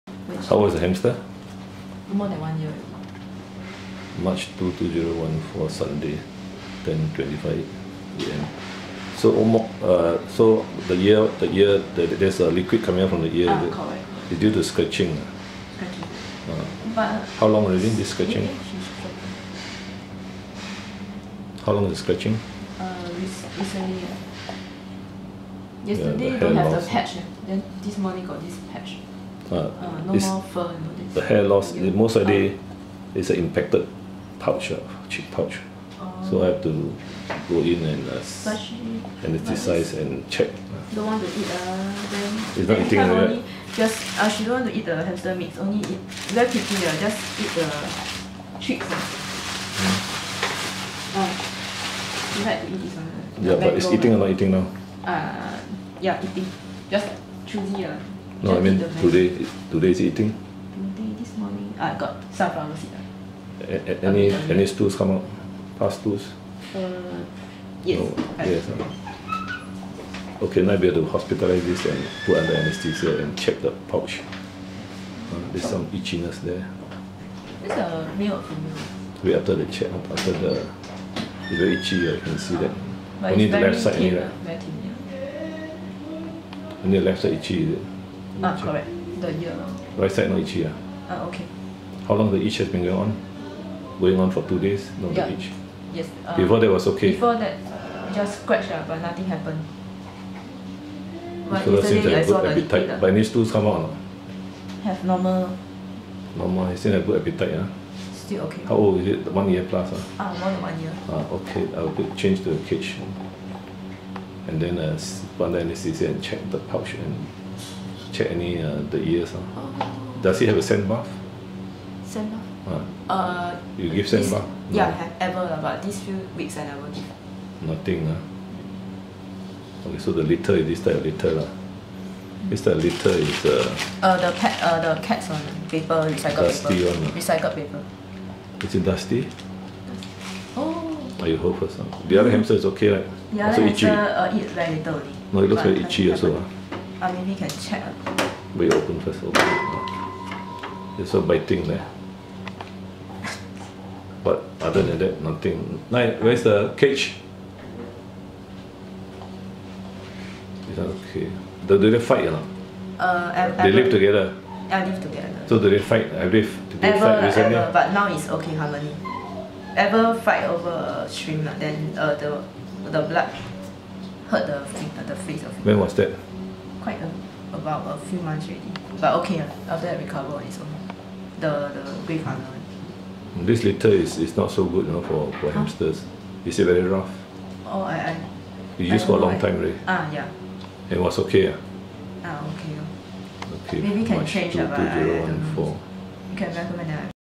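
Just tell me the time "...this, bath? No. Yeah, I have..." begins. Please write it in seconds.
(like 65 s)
124 s.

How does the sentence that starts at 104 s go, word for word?
Have normal Normal, still have good appetite yeah.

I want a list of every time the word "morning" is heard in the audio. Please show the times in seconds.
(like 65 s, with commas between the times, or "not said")
27 s, 61 s.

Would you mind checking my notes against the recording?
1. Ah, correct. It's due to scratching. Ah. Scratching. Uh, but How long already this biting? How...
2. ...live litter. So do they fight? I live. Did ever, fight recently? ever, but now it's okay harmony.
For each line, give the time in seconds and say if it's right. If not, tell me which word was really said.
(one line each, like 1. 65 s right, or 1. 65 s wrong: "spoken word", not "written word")
1. 13 s wrong: "scratching", not "biting"
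2. 164 s wrong: "together", not "litter".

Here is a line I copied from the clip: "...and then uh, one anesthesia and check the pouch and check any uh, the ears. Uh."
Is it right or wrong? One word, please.
right.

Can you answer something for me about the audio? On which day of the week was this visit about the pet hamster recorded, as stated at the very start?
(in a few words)
Sunday.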